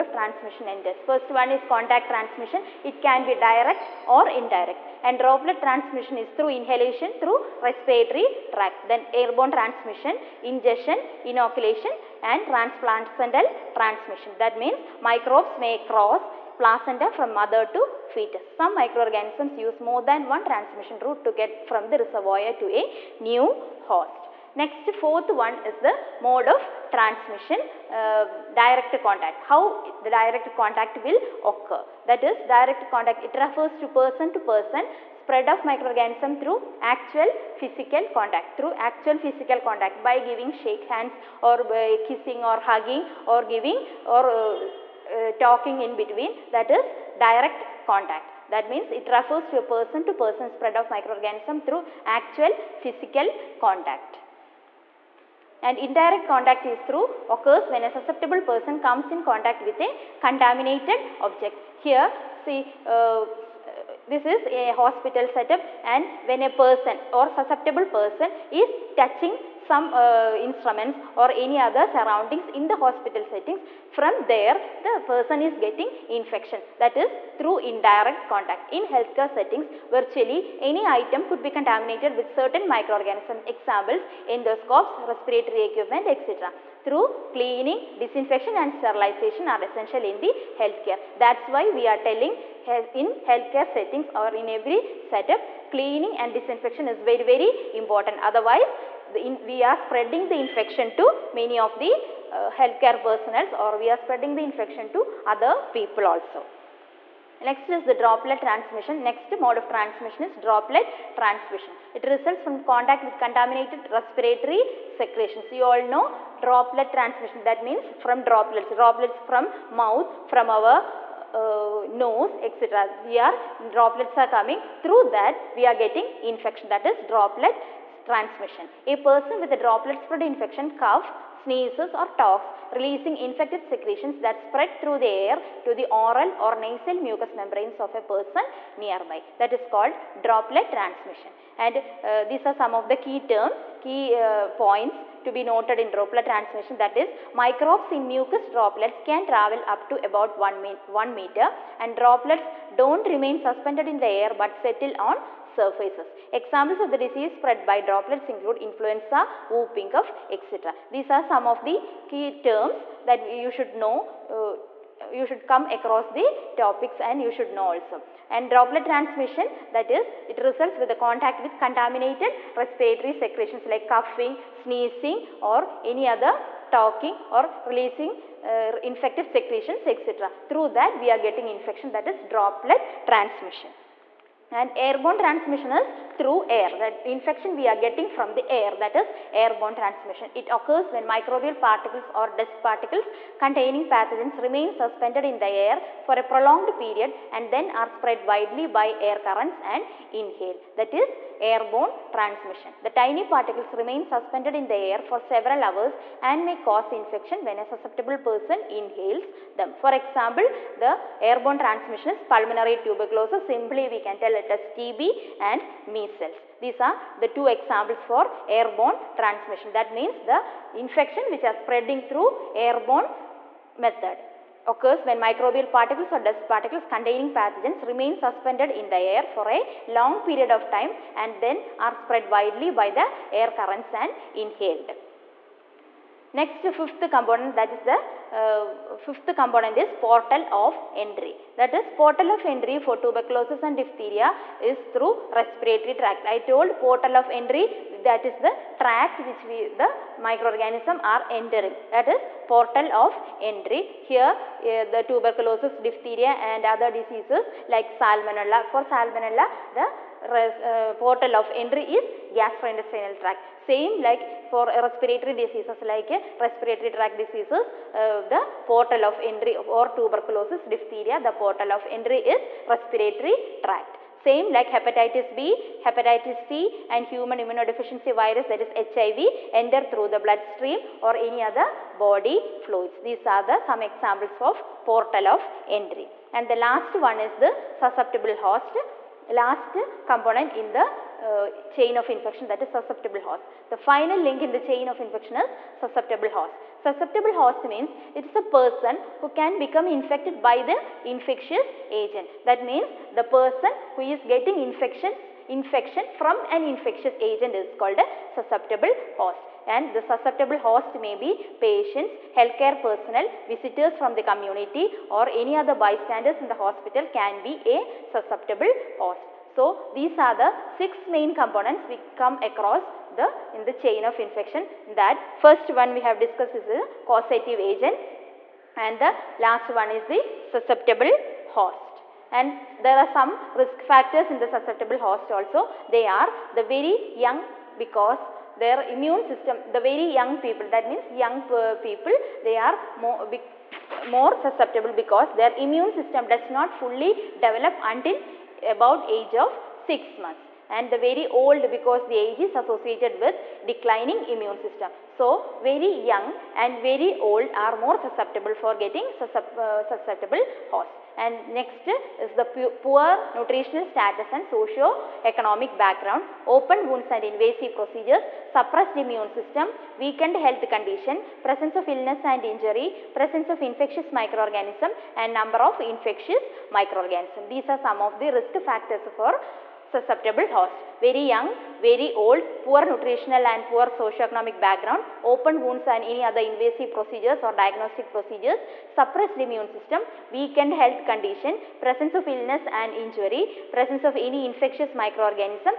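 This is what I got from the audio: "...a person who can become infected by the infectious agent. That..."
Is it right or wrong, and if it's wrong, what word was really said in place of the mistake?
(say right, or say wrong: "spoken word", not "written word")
right.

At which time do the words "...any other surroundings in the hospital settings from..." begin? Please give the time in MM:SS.
01:11.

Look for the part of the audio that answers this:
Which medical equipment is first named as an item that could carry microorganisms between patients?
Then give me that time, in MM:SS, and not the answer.
01:24.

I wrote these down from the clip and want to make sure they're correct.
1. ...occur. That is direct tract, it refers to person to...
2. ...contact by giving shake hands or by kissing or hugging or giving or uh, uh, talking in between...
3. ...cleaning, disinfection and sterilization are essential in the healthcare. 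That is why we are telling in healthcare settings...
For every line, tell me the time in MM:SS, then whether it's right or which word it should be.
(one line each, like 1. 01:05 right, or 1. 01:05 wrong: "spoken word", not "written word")
1. 00:31 wrong: "contact", not "tract"
2. 00:39 right
3. 01:27 right.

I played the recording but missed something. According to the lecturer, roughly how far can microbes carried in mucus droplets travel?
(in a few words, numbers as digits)
About 1 meter.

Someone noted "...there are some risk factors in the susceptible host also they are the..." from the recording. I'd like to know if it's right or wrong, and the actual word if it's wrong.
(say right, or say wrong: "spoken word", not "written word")
right.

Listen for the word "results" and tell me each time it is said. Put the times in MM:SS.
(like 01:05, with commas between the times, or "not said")
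01:52, 02:50.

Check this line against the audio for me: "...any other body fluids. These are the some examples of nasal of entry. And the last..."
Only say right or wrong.
wrong.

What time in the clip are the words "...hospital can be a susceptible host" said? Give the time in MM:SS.
05:16.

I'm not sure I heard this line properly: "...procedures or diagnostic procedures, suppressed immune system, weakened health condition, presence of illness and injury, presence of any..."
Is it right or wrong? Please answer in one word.
right.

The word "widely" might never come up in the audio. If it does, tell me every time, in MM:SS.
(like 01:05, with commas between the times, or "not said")
03:18, 03:52.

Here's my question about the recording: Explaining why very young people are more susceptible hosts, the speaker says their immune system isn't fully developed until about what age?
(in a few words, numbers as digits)
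6 months.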